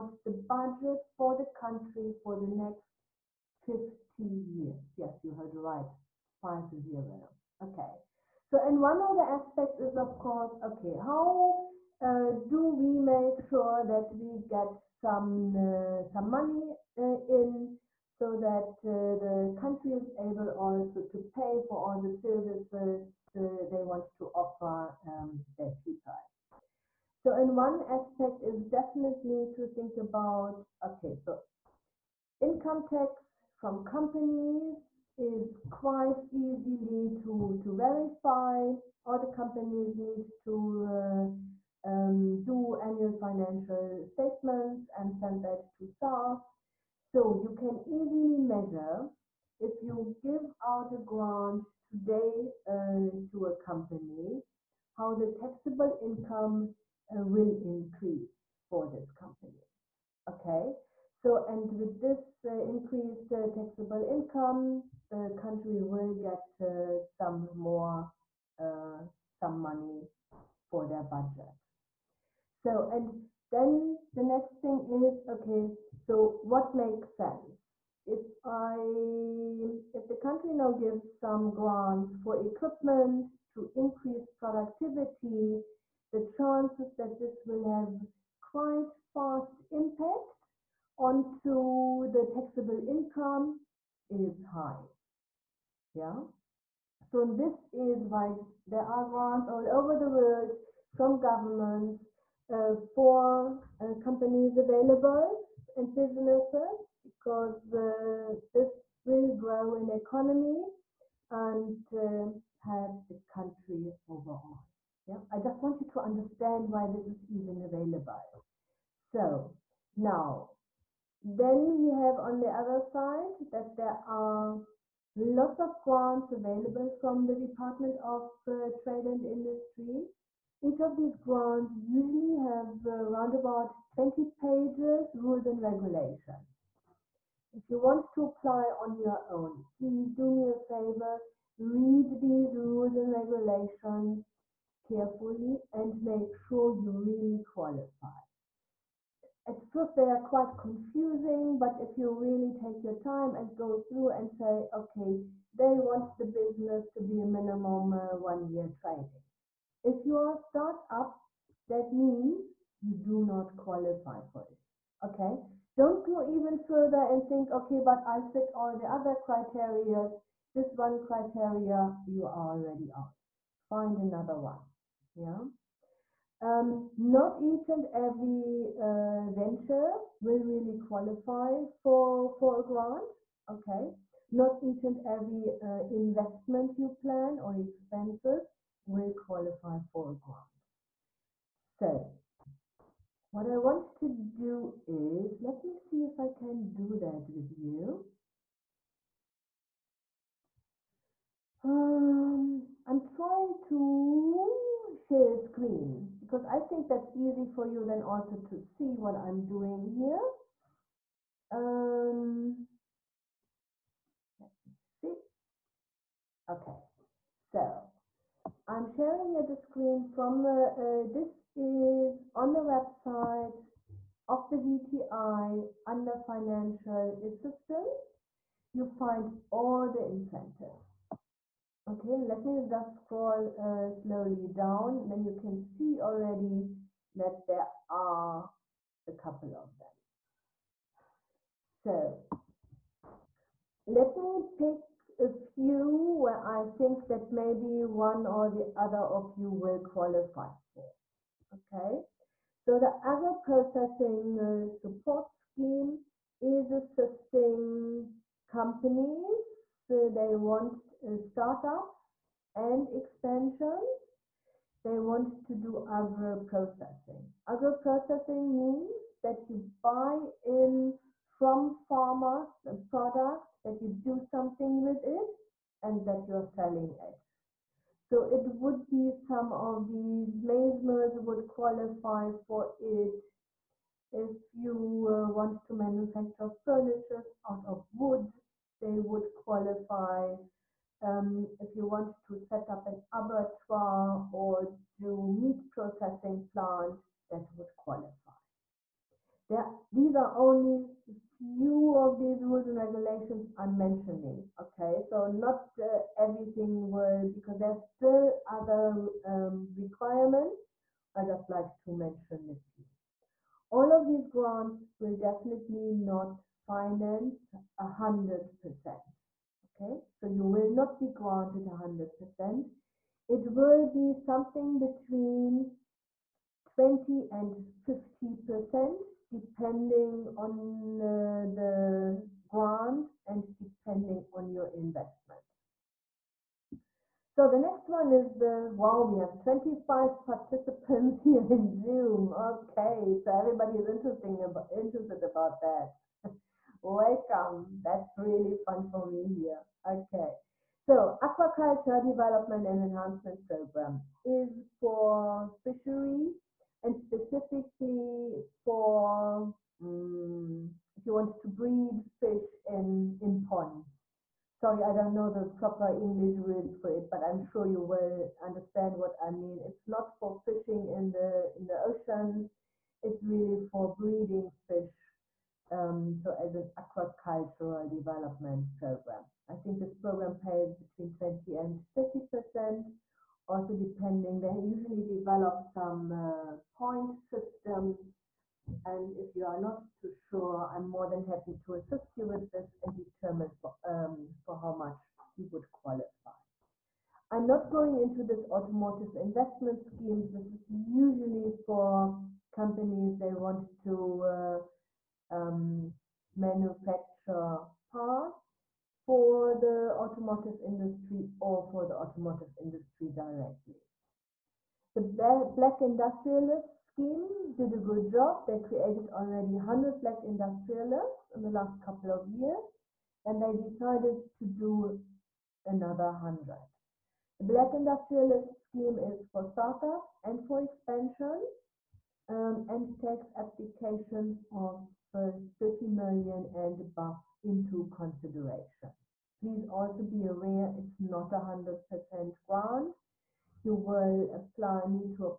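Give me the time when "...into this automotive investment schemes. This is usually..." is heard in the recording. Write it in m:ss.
6:37.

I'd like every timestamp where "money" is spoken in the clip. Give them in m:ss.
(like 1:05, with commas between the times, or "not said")
0:16, 1:09.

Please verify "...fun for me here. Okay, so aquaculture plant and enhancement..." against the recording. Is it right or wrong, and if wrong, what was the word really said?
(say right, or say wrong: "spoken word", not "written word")
wrong: "development", not "plant".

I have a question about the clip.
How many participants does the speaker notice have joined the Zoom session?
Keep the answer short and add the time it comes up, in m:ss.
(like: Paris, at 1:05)
25, at 5:39.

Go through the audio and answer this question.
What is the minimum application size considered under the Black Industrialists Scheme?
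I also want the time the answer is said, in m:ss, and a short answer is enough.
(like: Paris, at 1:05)
30 million, at 7:15.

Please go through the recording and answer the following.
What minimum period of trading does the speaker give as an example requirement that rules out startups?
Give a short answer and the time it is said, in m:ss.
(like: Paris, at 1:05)
1 year, at 2:38.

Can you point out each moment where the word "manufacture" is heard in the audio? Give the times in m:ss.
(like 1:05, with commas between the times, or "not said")
4:45, 6:46.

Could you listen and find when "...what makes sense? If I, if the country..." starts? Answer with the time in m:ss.
1:16.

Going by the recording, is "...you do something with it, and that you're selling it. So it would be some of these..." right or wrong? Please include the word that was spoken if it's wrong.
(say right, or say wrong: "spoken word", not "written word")
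right.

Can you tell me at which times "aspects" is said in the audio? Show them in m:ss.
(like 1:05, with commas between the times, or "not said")
0:09, 0:27.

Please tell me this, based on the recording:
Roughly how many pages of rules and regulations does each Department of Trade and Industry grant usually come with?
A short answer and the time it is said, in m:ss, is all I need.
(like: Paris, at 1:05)
20, at 2:13.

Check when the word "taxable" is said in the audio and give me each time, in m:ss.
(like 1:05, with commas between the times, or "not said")
0:55, 1:03, 1:32.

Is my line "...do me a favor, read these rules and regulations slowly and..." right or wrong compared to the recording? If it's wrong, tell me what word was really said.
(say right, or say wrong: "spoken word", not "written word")
wrong: "carefully", not "slowly".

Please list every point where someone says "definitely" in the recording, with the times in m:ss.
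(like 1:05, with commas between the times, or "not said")
0:28, 5:15.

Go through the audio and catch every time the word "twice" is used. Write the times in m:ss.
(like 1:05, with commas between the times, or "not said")
not said.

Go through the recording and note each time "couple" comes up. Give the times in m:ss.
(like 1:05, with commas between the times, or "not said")
3:59, 7:01.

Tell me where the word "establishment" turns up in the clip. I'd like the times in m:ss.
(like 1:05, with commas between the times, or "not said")
not said.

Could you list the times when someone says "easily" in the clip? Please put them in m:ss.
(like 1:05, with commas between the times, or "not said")
0:36, 0:47.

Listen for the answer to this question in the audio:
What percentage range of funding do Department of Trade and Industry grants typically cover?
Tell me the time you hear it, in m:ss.
5:24.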